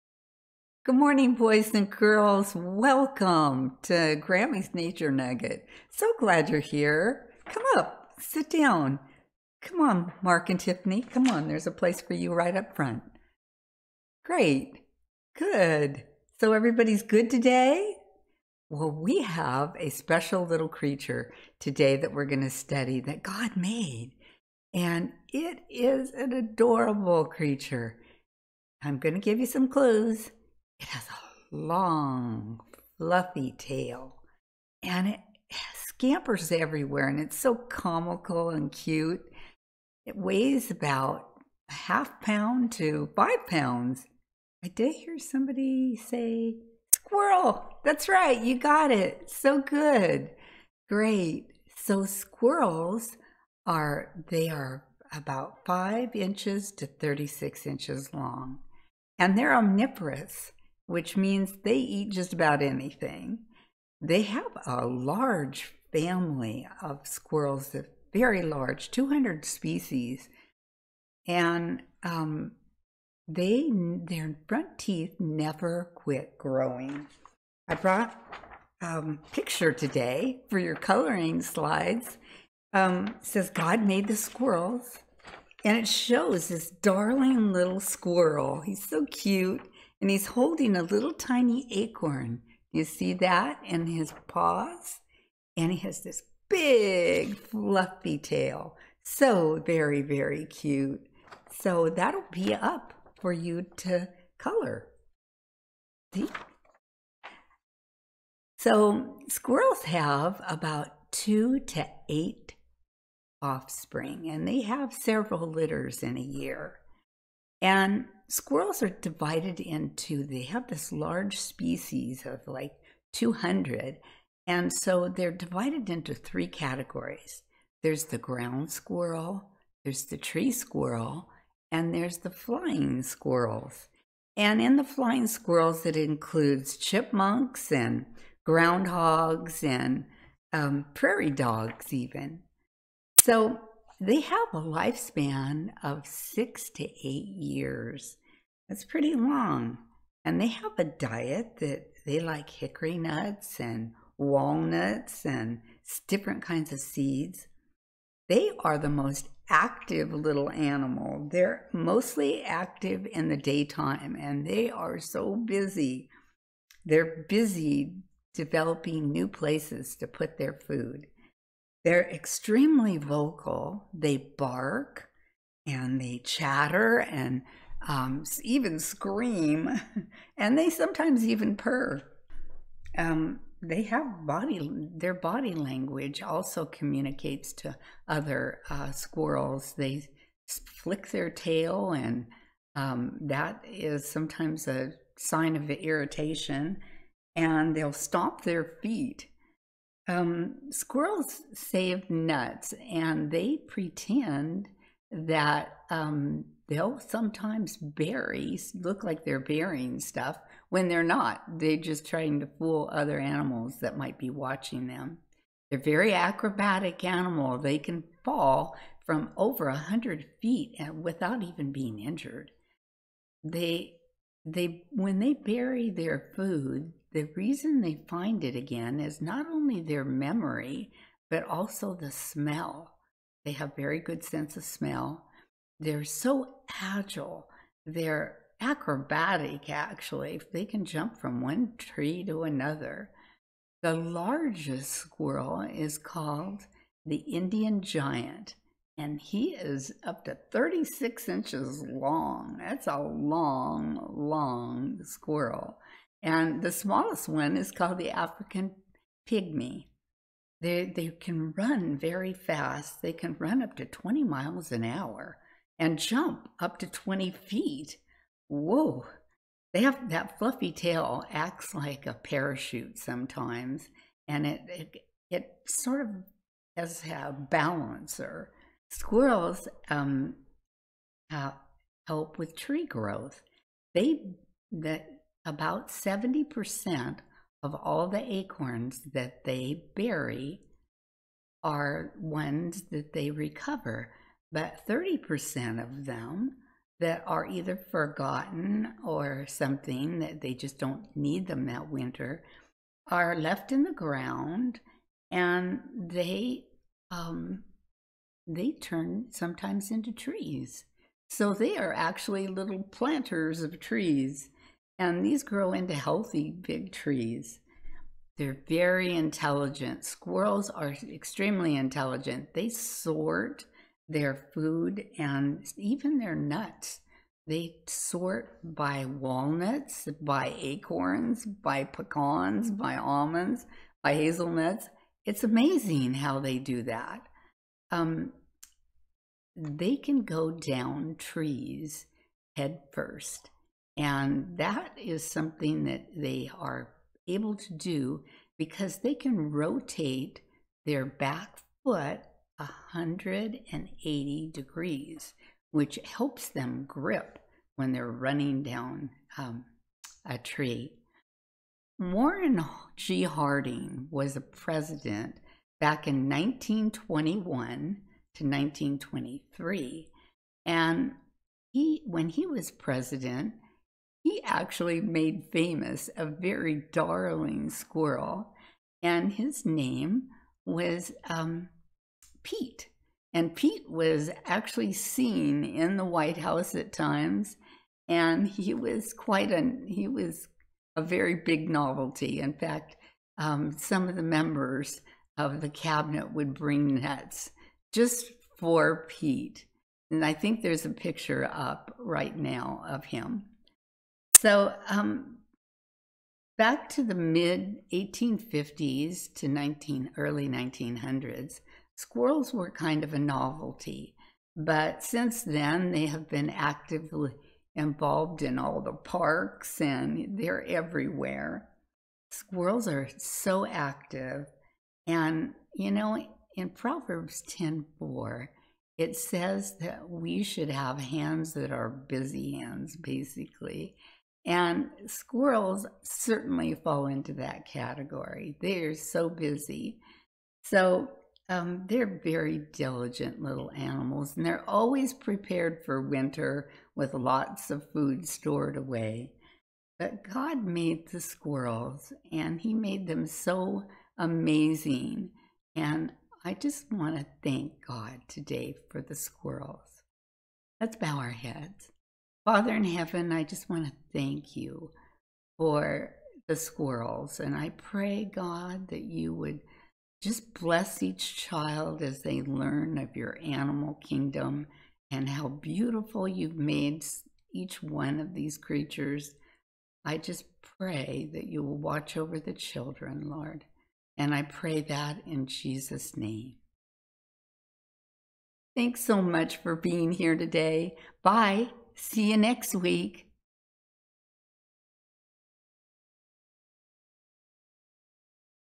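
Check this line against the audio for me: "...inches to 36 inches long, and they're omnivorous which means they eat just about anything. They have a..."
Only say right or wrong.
right.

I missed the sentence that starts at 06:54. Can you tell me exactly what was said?
But since then, they have been actively involved in all the parks and they're everywhere.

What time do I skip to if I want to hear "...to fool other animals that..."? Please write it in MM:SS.
03:32.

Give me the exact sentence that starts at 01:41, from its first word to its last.
So that'll be up for you to color.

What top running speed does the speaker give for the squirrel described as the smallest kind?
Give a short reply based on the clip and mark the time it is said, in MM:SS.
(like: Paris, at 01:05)
20 miles an hour, at 04:23.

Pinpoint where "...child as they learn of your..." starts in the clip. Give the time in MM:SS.
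07:51.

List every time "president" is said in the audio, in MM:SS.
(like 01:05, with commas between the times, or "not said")
06:04, 06:12.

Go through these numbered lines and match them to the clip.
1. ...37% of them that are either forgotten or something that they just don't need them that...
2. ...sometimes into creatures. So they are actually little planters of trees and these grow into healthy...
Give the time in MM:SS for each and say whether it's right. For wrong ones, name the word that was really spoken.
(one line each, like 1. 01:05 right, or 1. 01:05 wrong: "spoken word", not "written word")
1. 04:54 wrong: "30", not "37"
2. 05:09 wrong: "trees", not "creatures".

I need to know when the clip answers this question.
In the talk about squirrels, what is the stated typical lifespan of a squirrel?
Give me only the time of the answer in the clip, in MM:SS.
02:26.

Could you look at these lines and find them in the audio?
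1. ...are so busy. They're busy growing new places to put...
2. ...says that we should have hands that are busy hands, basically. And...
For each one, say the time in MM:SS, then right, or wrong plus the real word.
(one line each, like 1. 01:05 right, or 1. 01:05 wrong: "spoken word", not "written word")
1. 02:44 wrong: "developing", not "growing"
2. 07:09 right.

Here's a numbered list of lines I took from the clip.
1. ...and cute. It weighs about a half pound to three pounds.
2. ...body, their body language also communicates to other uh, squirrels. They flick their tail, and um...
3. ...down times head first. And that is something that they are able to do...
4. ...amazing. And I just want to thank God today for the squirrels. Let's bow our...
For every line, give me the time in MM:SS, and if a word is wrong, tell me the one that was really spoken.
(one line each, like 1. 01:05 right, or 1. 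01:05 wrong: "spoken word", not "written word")
1. 00:38 wrong: "five", not "three"
2. 03:04 right
3. 05:40 wrong: "trees", not "times"
4. 07:34 right.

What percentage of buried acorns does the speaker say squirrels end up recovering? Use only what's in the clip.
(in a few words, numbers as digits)
70%.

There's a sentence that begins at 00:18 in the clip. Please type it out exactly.
Well, we have a special little creature today that we're going to study that God made.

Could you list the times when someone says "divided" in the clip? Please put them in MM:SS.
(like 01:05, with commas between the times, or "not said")
01:58, 02:05.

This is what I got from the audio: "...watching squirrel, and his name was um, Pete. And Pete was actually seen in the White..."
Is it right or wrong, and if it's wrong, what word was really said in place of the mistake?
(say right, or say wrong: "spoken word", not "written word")
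wrong: "darling", not "watching".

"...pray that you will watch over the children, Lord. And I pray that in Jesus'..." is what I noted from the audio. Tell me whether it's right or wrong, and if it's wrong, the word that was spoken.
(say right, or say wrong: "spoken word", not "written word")
right.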